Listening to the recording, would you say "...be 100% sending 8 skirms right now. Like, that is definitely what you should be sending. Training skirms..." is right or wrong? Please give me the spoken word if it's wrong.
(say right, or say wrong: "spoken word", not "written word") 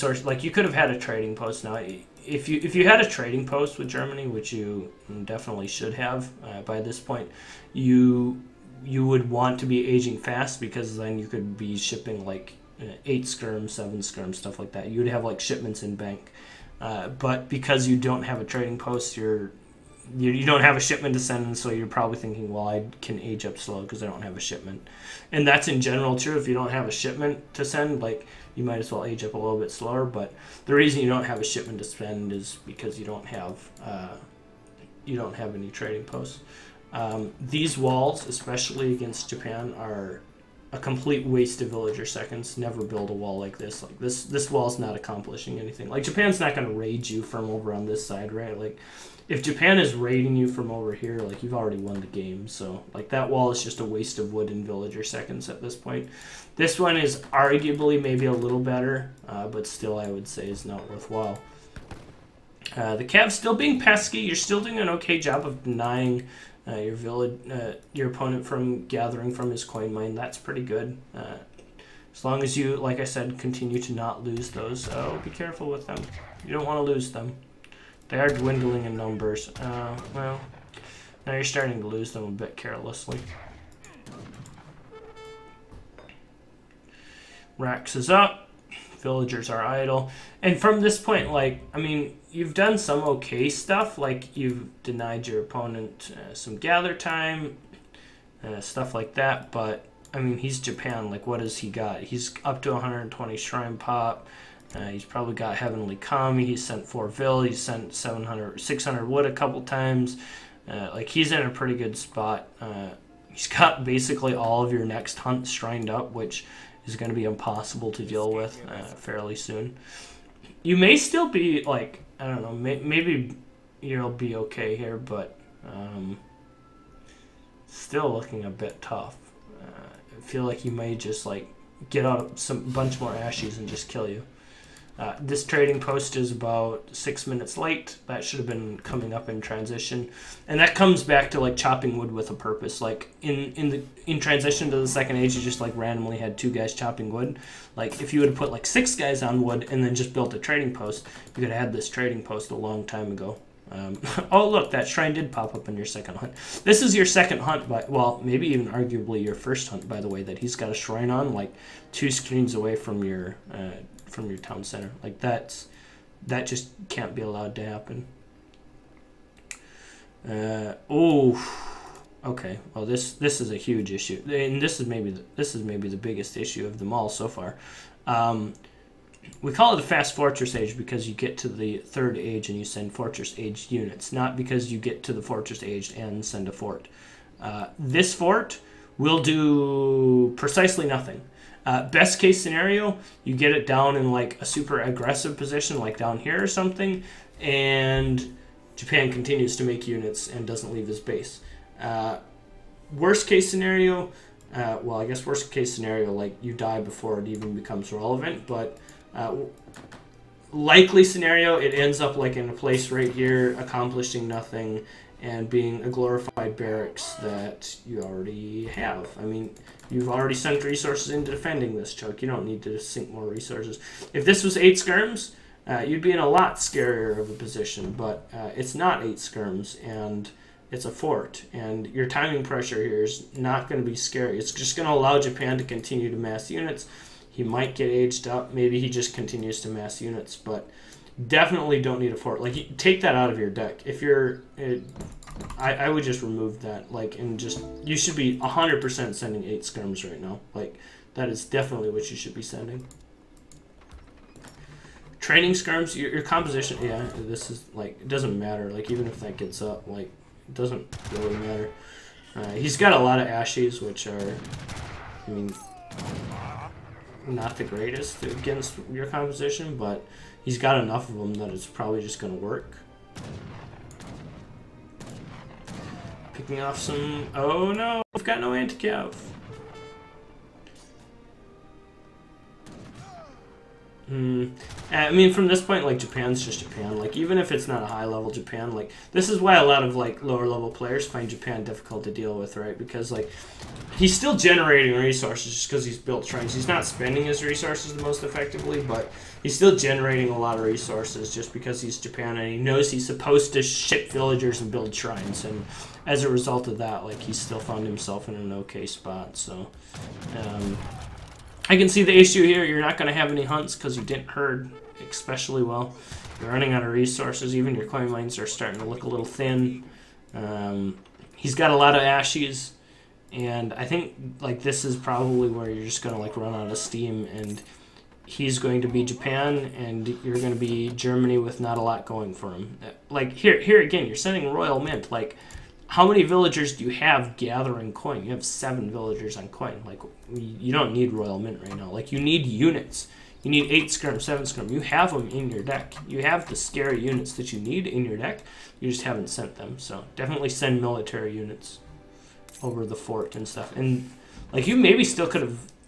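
right.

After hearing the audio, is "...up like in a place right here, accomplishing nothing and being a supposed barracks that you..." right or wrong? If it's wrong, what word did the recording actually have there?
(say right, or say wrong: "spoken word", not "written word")
wrong: "glorified", not "supposed".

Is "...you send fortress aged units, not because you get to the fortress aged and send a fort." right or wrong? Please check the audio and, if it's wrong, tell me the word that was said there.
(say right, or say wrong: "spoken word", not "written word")
right.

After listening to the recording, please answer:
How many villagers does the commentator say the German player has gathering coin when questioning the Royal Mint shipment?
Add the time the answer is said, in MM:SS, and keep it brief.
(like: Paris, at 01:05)
7, at 05:38.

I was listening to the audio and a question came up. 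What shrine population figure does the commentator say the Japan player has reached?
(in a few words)
120.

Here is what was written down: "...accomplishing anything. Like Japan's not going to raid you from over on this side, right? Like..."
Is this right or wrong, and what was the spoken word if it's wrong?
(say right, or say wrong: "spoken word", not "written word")
right.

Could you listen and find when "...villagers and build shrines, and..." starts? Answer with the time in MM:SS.
05:04.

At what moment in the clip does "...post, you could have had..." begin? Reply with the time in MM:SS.
02:30.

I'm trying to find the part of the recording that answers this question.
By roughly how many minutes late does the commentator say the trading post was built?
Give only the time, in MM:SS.
02:16.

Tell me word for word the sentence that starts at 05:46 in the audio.
You have the scary units that you need in your deck.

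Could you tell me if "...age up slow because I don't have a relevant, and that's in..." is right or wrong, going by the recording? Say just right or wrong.
wrong.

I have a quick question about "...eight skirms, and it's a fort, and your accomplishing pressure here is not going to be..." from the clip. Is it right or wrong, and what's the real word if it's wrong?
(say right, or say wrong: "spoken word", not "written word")
wrong: "timing", not "accomplishing".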